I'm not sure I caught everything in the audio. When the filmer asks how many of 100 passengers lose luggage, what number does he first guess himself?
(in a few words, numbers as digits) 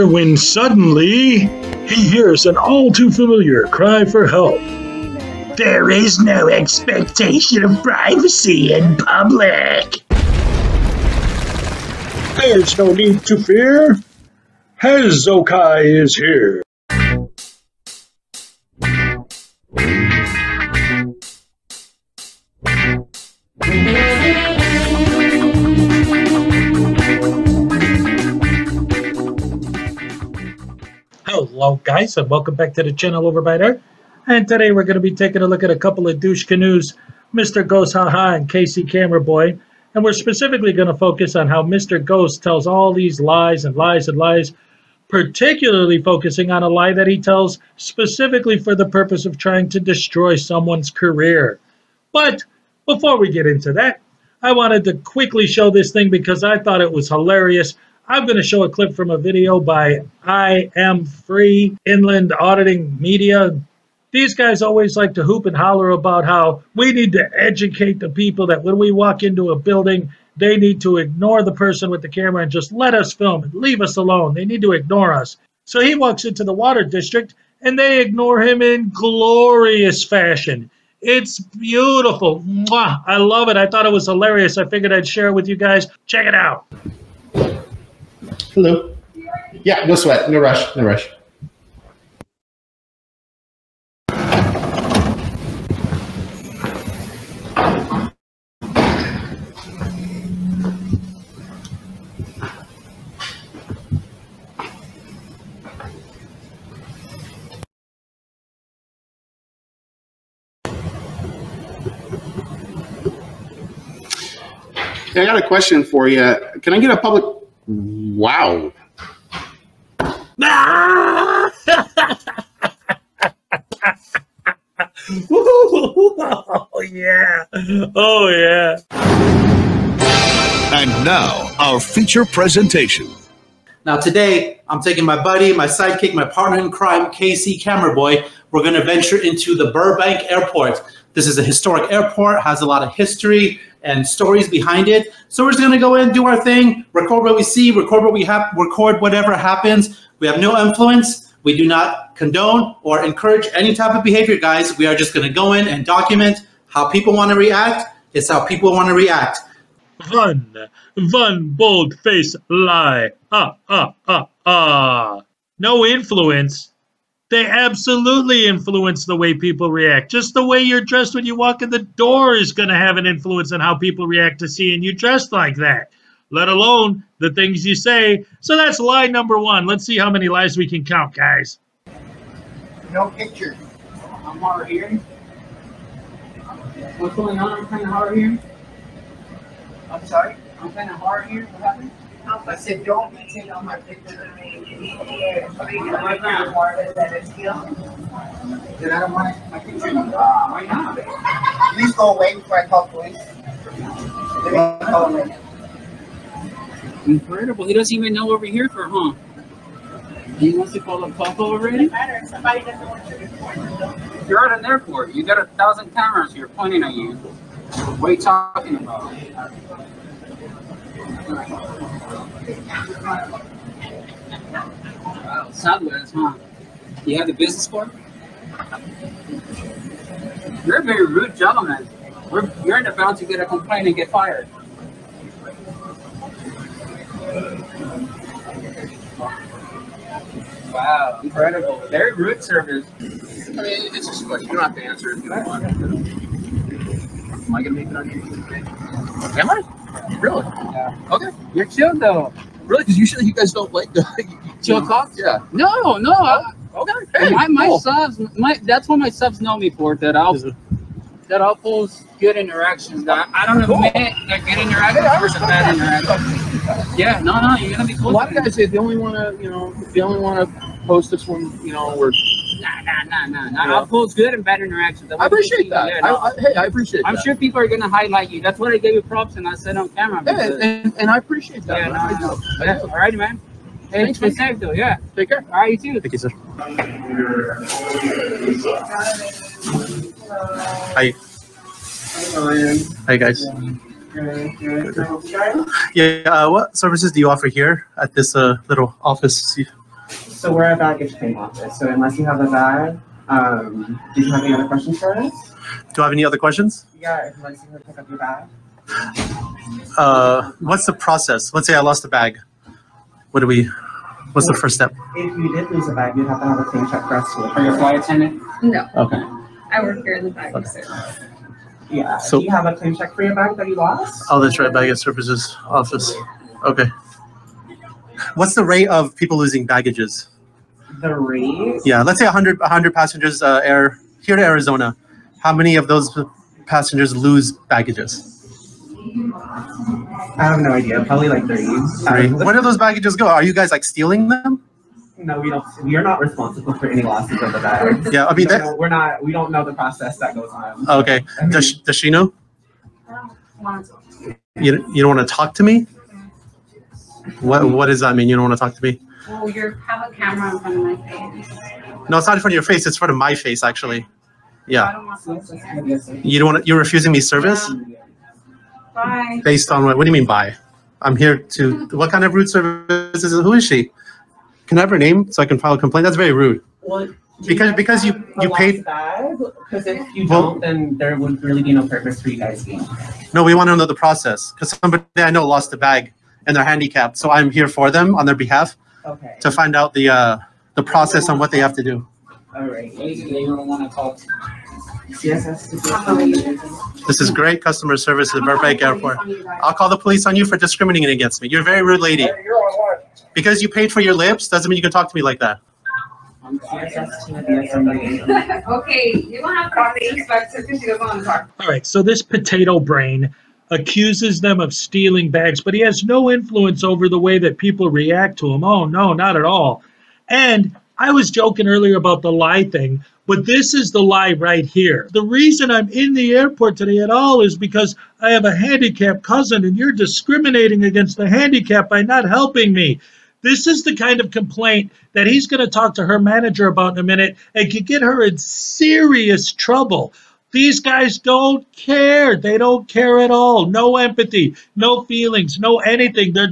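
30.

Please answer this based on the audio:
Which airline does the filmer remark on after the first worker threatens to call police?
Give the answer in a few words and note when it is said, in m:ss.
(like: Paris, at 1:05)
Southwest, at 3:45.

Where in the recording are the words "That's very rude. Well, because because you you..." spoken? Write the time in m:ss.
6:16.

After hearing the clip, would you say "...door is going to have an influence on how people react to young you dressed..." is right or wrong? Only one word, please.
wrong.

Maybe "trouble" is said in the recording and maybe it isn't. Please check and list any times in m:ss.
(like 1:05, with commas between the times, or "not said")
7:19.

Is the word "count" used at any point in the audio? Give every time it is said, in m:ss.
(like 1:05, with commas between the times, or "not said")
3:00.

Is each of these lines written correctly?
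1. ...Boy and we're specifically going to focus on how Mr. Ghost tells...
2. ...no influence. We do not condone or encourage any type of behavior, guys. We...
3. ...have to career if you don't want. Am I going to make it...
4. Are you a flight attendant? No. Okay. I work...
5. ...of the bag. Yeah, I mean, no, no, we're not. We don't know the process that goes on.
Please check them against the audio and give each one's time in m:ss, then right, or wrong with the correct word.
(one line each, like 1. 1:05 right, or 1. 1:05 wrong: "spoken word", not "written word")
1. 0:39 right
2. 2:30 right
3. 4:04 wrong: "answer", not "career"
4. 5:17 right
5. 5:47 right.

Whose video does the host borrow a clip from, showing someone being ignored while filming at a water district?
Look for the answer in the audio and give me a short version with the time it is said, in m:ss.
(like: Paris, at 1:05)
Inland Auditing Media, at 1:01.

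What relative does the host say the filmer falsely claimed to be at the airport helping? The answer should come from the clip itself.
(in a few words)
cousin.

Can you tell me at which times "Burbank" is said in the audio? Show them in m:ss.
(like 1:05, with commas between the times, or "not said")
2:19, 6:38.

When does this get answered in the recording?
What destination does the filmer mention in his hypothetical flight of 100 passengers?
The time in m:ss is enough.
5:34.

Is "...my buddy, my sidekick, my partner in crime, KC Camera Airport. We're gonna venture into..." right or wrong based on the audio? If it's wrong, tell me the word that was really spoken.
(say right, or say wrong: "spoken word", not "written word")
wrong: "Boy", not "Airport".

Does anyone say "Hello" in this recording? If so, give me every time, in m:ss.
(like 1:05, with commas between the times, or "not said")
0:31, 1:28.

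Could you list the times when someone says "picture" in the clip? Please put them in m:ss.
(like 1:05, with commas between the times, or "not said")
3:03, 3:13.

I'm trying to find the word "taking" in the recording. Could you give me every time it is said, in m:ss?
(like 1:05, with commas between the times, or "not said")
0:35, 2:14.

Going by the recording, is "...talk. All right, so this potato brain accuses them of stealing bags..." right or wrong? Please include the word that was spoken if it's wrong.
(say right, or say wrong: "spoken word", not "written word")
right.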